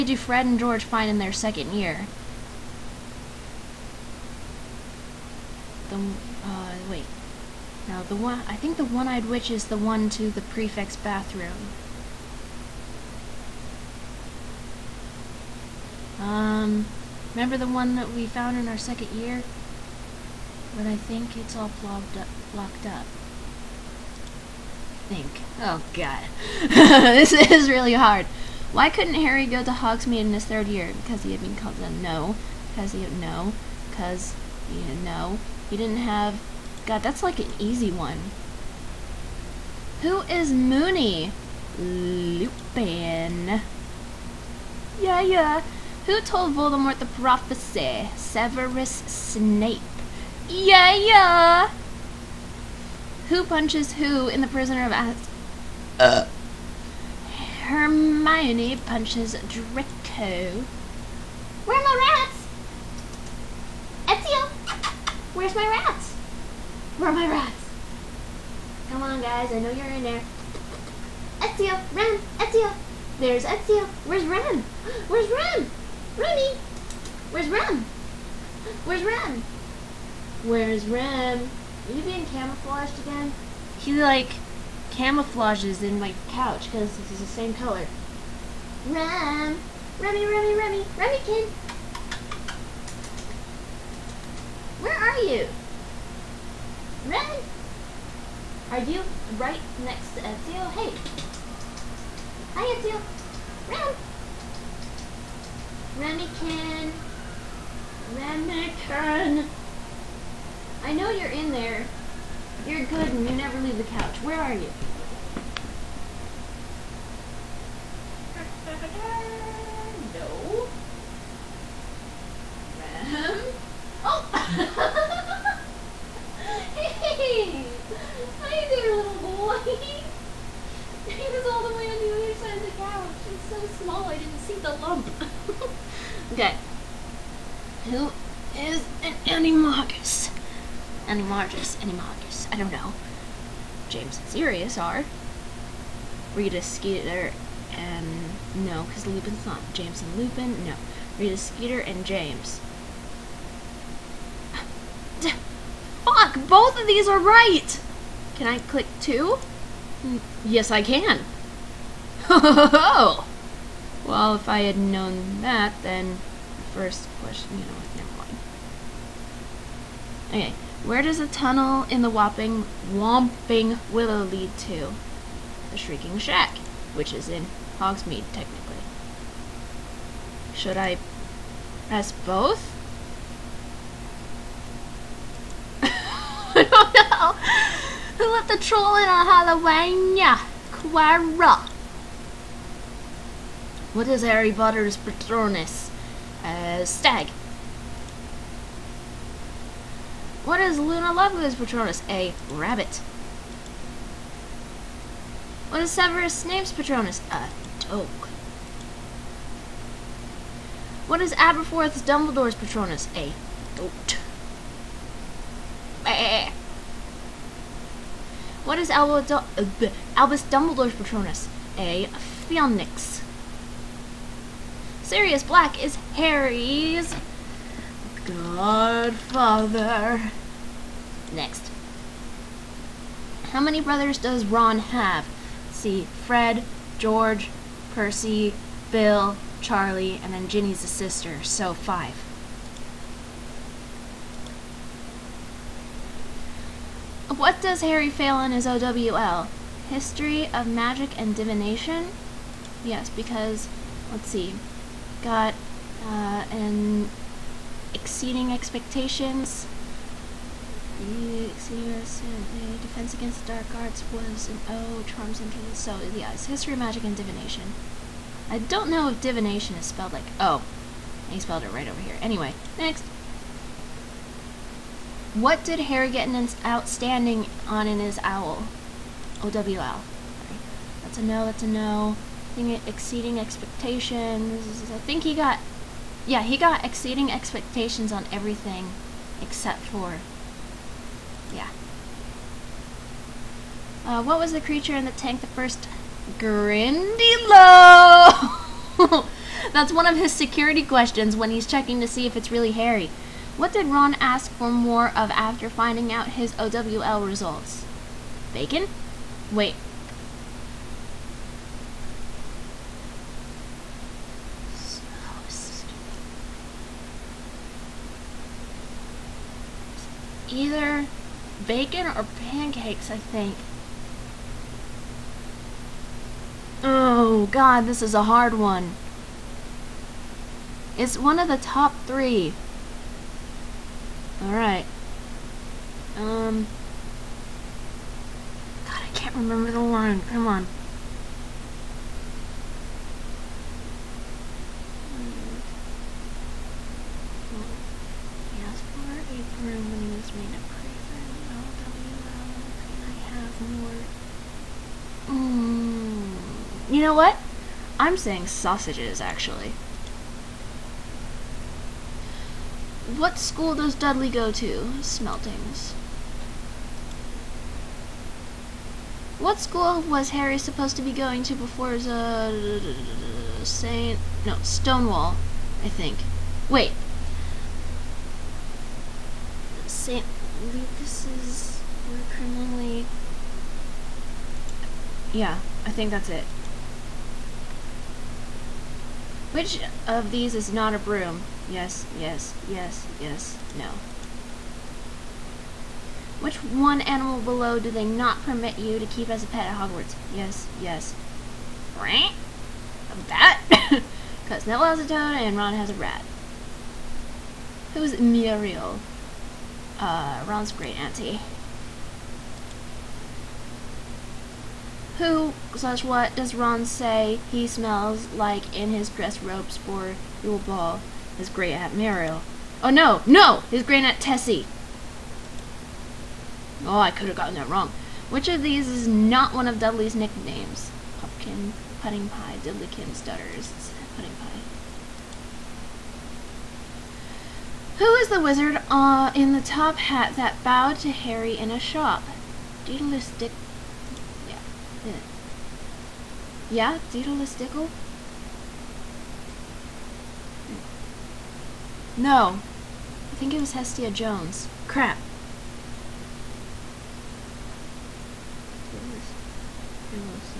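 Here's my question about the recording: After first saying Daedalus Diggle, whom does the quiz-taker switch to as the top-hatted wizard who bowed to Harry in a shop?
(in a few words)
Hestia Jones.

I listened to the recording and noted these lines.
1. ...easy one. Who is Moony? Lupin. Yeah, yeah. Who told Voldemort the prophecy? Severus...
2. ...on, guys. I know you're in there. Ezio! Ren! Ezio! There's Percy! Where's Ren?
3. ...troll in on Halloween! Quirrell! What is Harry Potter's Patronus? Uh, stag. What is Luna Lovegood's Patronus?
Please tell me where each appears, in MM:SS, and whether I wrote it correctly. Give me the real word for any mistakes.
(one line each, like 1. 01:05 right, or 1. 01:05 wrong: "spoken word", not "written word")
1. 00:37 right
2. 01:09 wrong: "Ezio", not "Percy"
3. 03:08 right.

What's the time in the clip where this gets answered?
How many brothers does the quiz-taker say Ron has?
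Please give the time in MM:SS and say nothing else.
04:01.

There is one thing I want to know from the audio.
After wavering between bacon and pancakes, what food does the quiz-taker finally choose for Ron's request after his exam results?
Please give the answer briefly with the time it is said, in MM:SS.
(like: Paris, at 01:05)
Sausages, at 05:58.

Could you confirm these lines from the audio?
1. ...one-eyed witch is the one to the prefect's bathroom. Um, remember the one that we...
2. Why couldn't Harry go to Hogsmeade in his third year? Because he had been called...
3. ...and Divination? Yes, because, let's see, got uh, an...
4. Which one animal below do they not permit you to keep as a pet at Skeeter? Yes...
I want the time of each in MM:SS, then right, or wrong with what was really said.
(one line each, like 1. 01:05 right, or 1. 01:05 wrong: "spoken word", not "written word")
1. 00:08 right
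2. 00:28 right
3. 04:11 right
4. 06:36 wrong: "Hogwarts", not "Skeeter".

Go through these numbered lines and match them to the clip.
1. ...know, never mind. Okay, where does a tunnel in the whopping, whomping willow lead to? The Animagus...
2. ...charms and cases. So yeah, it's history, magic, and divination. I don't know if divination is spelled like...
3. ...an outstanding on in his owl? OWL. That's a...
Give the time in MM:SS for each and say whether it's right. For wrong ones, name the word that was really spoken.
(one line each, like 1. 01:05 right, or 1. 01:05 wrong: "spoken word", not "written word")
1. 02:47 wrong: "Shrieking", not "Animagus"
2. 04:25 right
3. 04:36 right.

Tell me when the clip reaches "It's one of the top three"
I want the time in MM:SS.
05:30.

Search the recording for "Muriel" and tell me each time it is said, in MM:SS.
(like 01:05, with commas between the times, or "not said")
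06:48, 07:01.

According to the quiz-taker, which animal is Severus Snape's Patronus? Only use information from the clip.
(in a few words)
A dog.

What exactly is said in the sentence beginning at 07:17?
Who is the wizard uh, in the top hat that bowed to Harry in a shop?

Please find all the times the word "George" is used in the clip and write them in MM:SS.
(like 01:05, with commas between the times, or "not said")
00:00, 03:56.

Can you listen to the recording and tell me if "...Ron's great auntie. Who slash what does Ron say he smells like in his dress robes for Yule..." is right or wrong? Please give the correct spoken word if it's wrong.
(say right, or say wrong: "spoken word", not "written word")
right.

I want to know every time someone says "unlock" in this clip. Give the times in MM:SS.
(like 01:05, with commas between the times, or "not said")
not said.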